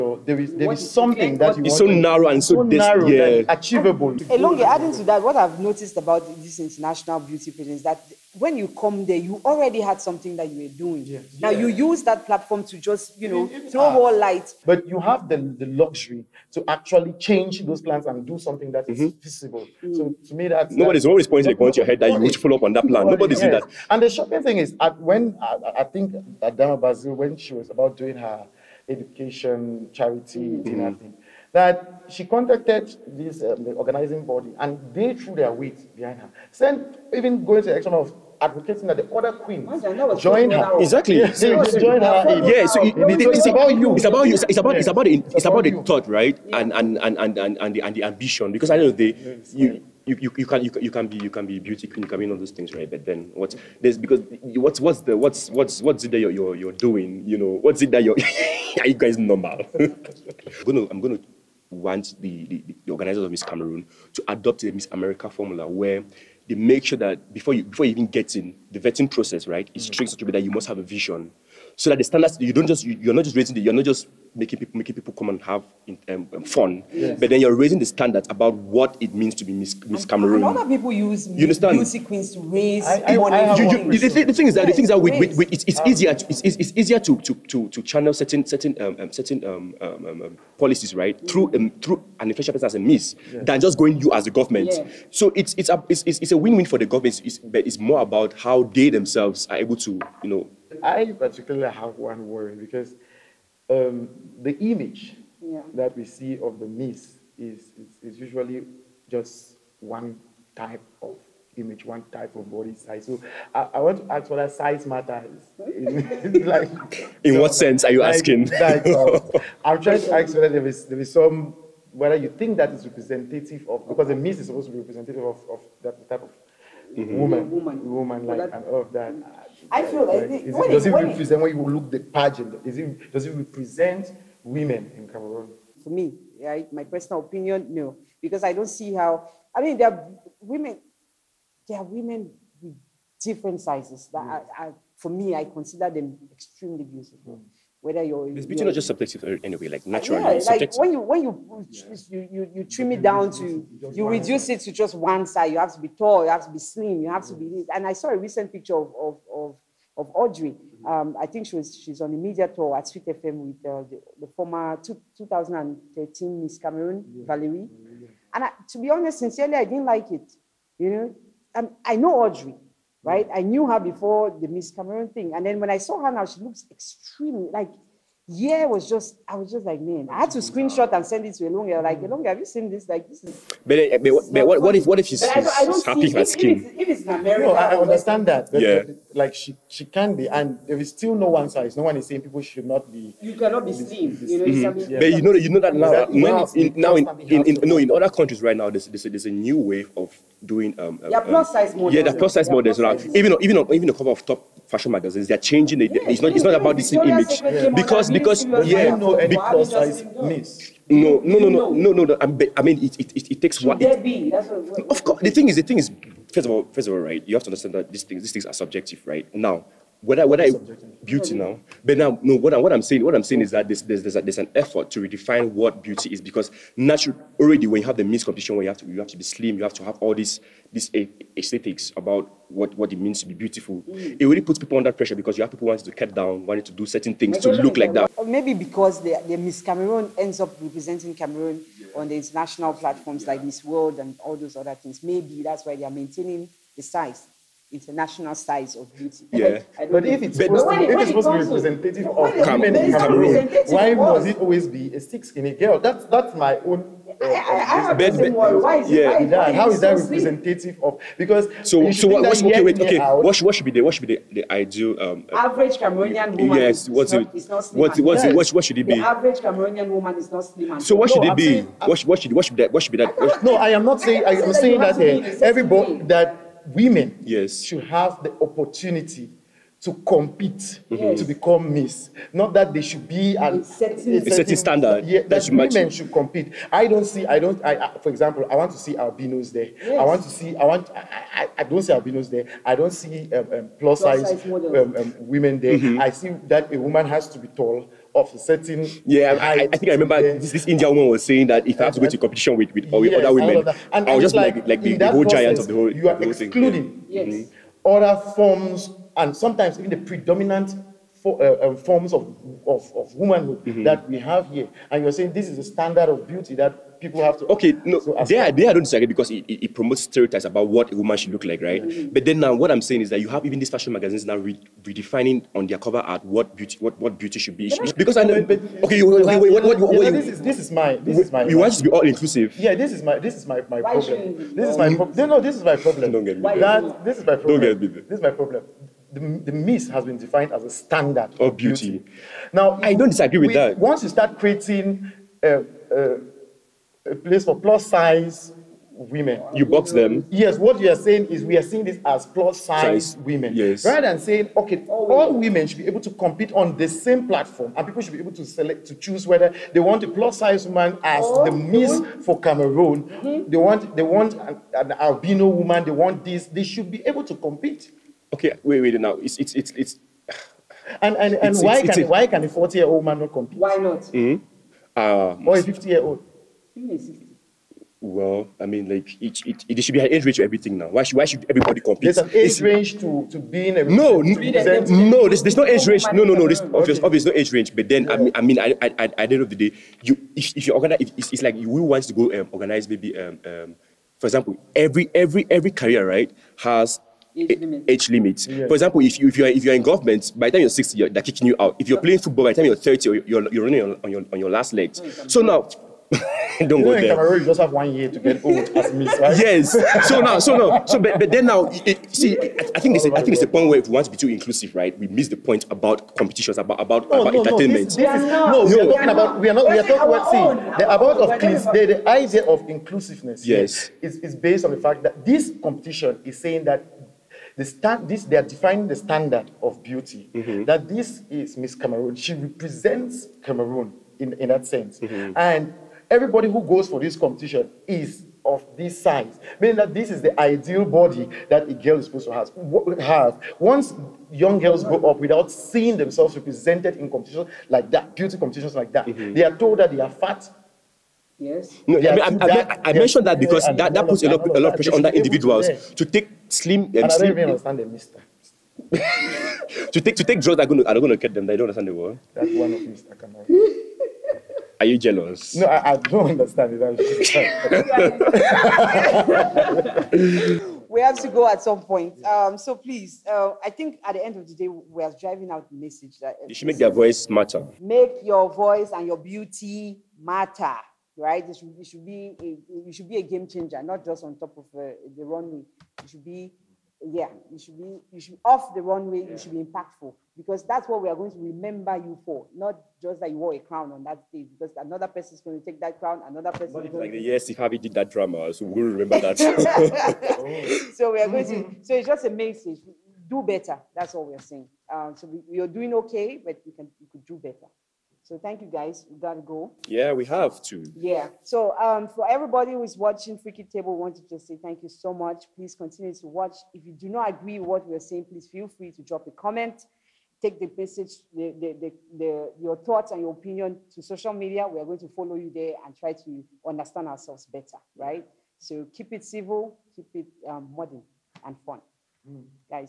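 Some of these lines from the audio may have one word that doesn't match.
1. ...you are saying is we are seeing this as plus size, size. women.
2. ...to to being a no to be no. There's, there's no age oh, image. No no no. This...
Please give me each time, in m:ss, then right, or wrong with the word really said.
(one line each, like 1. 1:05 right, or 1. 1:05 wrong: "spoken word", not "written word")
1. 5:50 right
2. 6:22 wrong: "range", not "image".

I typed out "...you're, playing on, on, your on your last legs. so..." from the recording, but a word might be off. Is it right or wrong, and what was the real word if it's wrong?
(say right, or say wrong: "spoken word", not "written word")
wrong: "running", not "playing".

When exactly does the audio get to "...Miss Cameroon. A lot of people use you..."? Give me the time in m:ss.
1:19.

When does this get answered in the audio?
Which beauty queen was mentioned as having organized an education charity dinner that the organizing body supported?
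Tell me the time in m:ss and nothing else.
0:26.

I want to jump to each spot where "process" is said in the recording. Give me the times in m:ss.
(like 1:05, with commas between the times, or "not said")
1:09, 5:05.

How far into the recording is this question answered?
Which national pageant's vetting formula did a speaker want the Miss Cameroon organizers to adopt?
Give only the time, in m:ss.
1:04.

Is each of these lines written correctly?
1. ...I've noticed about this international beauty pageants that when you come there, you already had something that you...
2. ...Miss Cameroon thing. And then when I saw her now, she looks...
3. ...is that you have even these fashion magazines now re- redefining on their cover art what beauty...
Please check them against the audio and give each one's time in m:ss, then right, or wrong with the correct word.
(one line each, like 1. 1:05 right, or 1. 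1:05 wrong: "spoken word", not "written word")
1. 0:05 right
2. 2:54 right
3. 5:23 right.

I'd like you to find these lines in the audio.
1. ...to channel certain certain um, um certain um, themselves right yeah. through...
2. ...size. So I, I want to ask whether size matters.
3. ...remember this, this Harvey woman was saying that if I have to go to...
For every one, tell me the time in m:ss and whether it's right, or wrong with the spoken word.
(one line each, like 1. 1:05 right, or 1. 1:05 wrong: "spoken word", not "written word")
1. 1:27 wrong: "policies", not "themselves"
2. 1:52 right
3. 4:59 wrong: "Indian", not "Harvey".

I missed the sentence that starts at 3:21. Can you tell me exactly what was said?
Yeah, the plus size yeah, models.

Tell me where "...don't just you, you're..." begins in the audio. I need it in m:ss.
1:12.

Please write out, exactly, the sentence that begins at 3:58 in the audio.
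maybe because the, the Miss Cameroon ends up representing Cameroon on international platforms yeah.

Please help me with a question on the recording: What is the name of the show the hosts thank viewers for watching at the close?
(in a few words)
Freaky Table.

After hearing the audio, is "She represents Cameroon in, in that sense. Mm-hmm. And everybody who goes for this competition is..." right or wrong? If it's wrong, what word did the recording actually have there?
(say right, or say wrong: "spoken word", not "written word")
right.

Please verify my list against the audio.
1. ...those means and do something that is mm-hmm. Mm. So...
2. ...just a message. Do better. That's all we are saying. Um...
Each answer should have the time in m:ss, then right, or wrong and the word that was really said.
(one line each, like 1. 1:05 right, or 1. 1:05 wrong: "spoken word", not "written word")
1. 0:17 wrong: "plans", not "means"
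2. 8:22 right.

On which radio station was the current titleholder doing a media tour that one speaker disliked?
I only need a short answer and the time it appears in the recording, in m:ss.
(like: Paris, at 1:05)
Sweet FM, at 2:42.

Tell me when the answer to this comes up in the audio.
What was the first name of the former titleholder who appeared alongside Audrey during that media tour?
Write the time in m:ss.
2:47.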